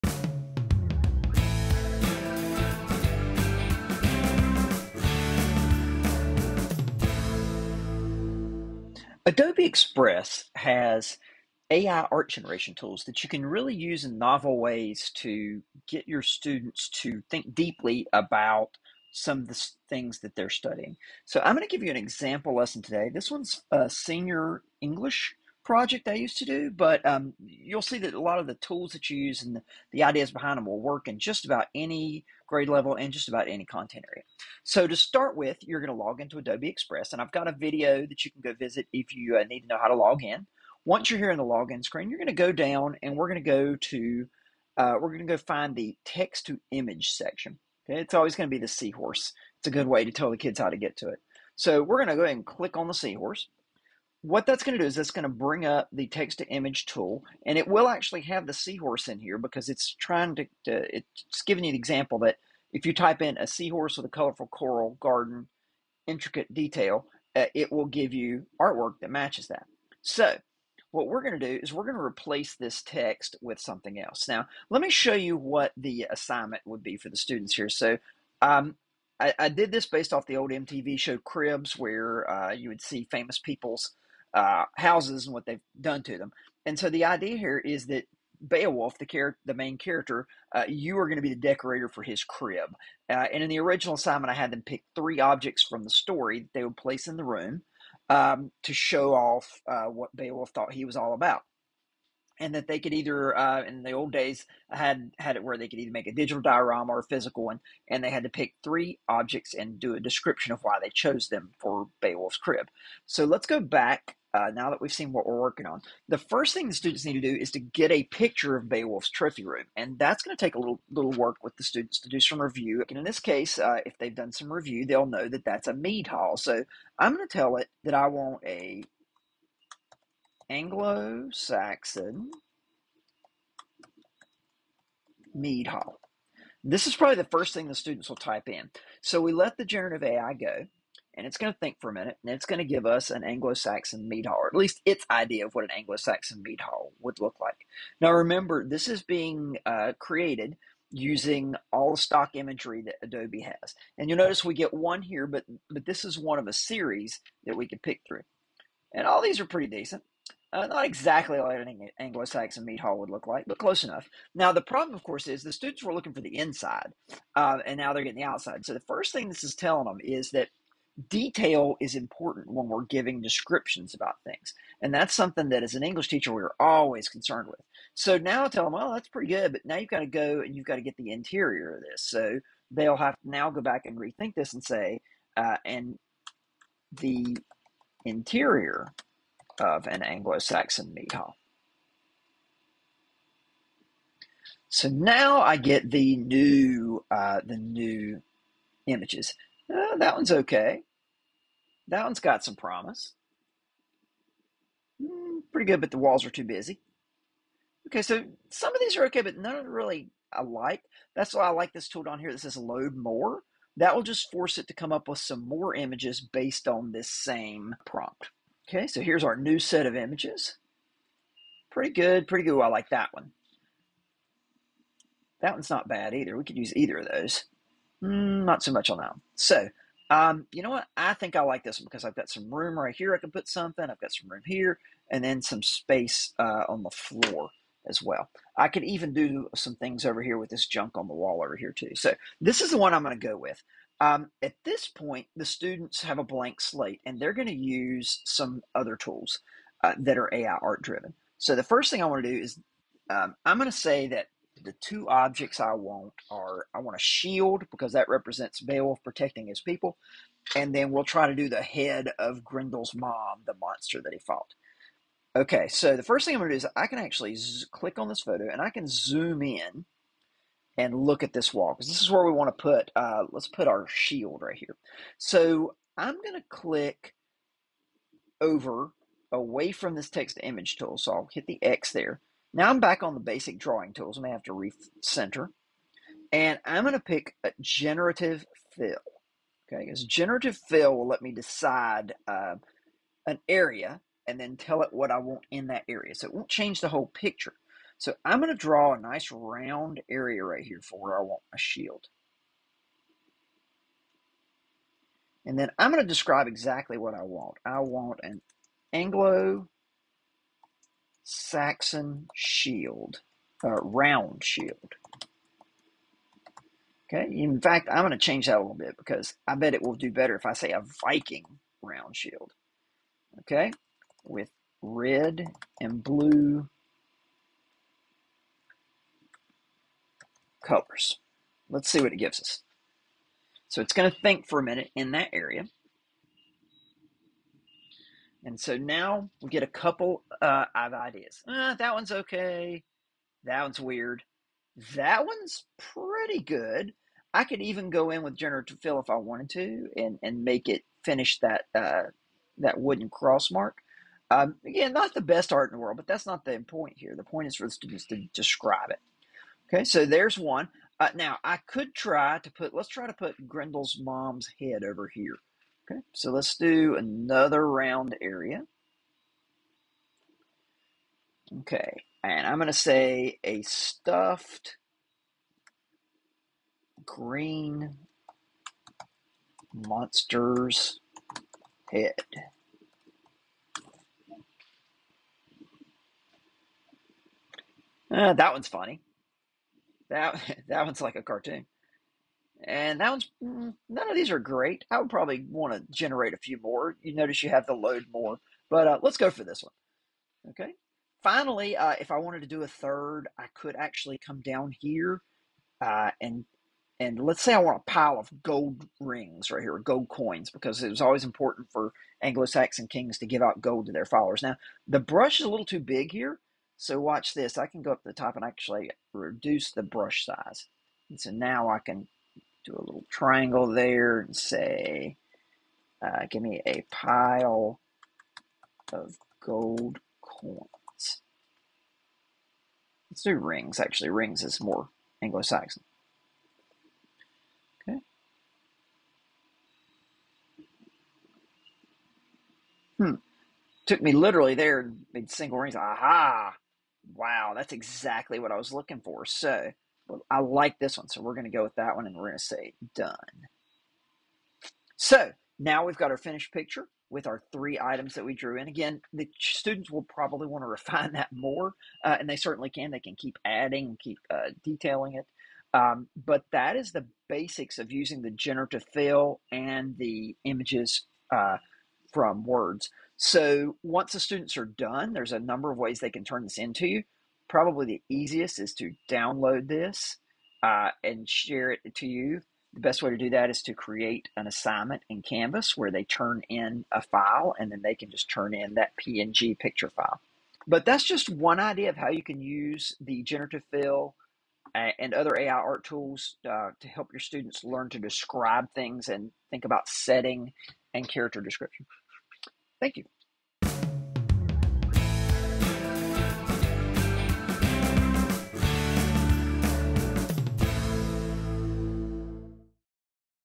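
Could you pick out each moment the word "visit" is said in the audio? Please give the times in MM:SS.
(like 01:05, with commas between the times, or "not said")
00:38.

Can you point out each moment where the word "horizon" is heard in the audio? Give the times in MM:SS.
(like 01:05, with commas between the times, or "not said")
not said.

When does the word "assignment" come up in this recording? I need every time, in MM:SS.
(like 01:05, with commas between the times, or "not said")
01:16, 01:33, 08:04.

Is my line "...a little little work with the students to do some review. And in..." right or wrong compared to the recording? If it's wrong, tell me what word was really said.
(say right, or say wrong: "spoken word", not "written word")
right.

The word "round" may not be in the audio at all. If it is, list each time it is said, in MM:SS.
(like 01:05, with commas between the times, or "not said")
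04:59, 05:13, 05:21, 06:07.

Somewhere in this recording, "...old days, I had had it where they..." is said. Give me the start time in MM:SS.
01:43.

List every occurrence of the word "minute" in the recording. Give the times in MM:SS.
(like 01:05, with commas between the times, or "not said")
02:21, 05:34.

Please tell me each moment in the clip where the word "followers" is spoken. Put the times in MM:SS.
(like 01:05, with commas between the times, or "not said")
06:54.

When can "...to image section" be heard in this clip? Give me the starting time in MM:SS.
00:46.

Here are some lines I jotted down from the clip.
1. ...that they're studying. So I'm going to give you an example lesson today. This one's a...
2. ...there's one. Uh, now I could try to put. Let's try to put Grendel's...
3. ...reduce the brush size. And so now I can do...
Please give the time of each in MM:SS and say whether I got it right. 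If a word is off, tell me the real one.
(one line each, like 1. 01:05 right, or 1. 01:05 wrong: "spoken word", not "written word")
1. 00:20 right
2. 06:00 right
3. 06:59 right.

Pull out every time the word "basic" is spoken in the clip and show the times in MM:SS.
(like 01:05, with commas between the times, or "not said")
04:43, 07:47.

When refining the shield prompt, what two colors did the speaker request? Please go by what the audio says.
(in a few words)
Red and blue.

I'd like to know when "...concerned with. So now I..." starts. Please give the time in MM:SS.
02:57.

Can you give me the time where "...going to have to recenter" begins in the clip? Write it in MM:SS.
04:44.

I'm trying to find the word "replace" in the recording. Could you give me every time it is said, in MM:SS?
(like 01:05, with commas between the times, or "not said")
01:12.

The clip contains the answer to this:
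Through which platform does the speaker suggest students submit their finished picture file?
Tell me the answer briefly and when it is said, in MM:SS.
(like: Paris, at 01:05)
Canvas, at 08:05.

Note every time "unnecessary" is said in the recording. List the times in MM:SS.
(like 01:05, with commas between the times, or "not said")
not said.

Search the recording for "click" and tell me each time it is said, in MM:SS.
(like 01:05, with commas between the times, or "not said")
00:52, 04:27, 04:36.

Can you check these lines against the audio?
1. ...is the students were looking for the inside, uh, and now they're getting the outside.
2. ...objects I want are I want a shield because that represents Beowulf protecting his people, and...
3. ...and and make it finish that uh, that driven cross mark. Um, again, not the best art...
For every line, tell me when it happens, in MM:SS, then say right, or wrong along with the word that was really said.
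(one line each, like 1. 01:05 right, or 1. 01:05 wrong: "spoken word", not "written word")
1. 02:45 right
2. 04:15 right
3. 05:49 wrong: "wooden", not "driven".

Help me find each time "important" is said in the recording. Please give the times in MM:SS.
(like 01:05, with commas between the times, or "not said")
02:51, 06:51.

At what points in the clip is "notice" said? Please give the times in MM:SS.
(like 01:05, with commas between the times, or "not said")
02:34, 06:37.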